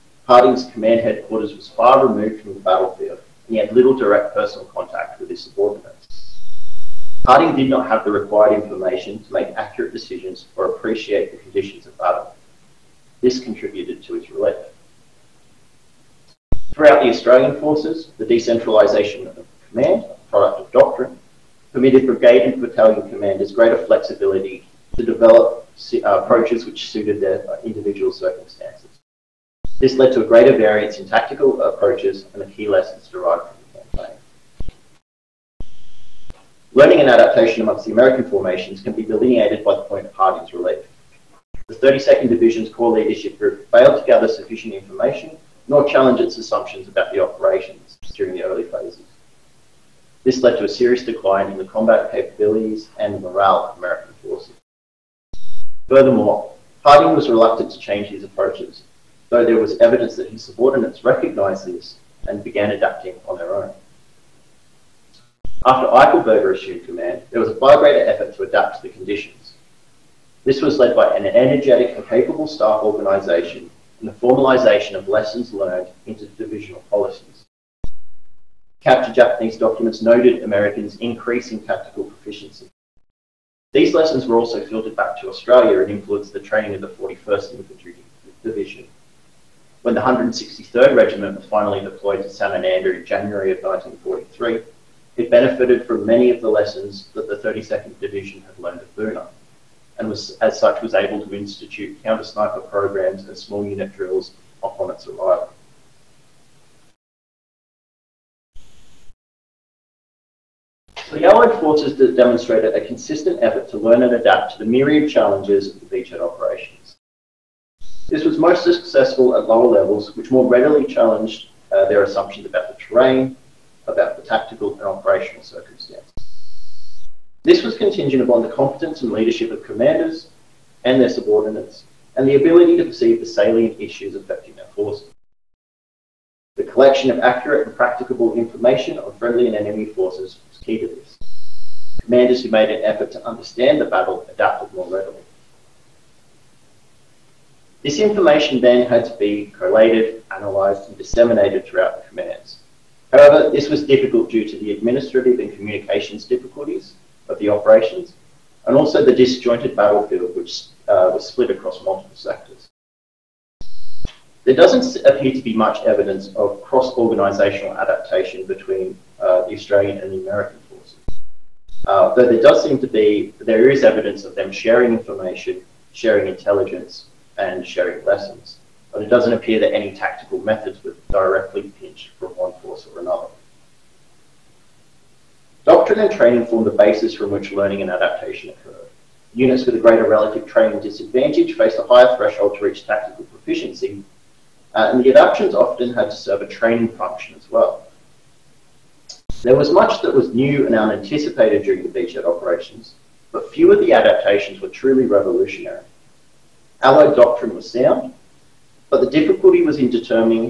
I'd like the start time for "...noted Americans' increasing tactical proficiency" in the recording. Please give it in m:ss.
1:20.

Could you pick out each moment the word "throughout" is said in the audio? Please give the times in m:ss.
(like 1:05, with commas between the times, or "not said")
0:16, 2:31.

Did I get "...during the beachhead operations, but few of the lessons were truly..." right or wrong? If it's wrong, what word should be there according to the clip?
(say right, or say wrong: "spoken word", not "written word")
wrong: "adaptations", not "lessons".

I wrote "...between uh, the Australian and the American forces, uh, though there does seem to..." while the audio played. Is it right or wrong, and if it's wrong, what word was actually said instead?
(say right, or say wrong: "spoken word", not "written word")
right.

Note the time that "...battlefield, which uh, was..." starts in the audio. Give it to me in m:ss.
2:39.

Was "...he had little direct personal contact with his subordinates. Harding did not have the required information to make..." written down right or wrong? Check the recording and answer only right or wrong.
right.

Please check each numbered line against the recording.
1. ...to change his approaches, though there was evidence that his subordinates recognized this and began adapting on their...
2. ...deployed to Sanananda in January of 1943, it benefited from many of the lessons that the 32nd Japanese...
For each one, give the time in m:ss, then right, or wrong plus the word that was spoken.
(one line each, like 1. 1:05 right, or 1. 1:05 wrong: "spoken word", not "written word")
1. 0:57 right
2. 1:31 wrong: "Division", not "Japanese".